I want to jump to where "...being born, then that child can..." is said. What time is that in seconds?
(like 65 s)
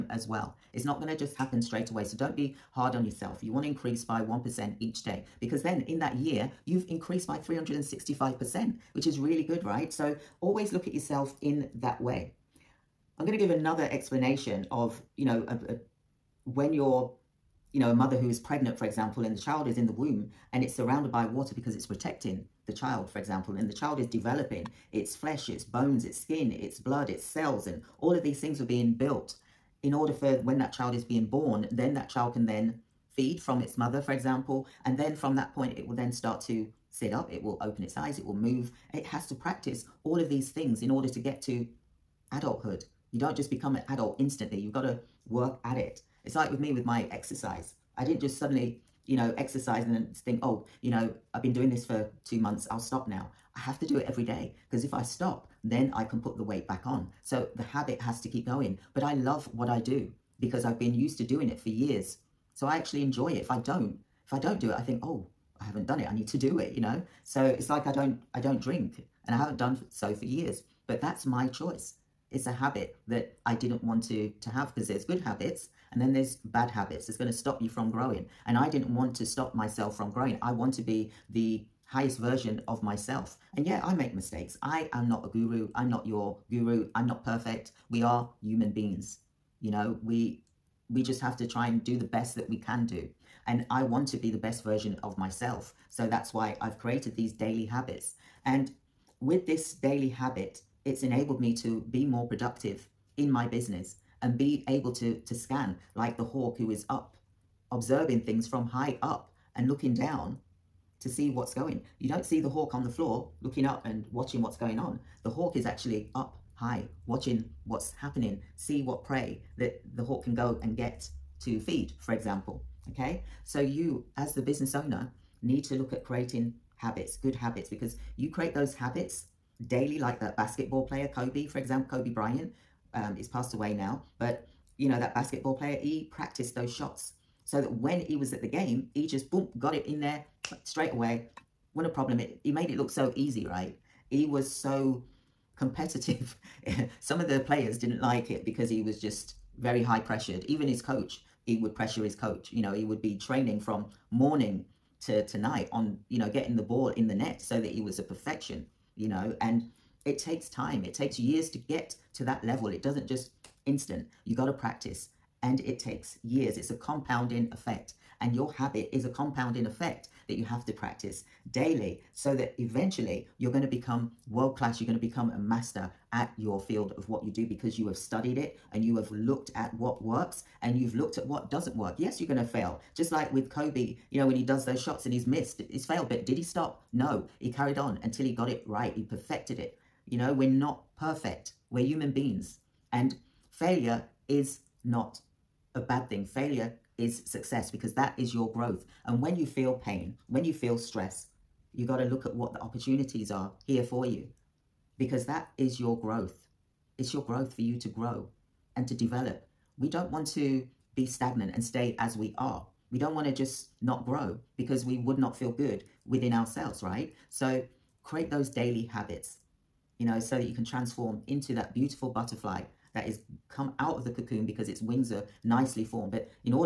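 31 s.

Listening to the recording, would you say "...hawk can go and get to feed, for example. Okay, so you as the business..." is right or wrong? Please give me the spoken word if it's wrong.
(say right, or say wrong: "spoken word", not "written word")
right.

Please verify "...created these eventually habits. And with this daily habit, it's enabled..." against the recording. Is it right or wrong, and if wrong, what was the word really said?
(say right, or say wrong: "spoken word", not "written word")
wrong: "daily", not "eventually".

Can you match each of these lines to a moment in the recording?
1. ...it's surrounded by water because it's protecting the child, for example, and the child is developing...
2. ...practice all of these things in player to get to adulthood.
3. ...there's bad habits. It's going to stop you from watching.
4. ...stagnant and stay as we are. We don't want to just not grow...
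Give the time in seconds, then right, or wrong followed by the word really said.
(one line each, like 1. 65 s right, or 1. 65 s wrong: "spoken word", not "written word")
1. 20 s right
2. 39 s wrong: "order", not "player"
3. 76 s wrong: "growing", not "watching"
4. 211 s right.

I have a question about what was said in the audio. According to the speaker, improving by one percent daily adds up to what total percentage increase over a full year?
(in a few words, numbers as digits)
365%.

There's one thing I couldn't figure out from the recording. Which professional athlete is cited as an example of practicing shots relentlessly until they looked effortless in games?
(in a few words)
Kobe Bryant.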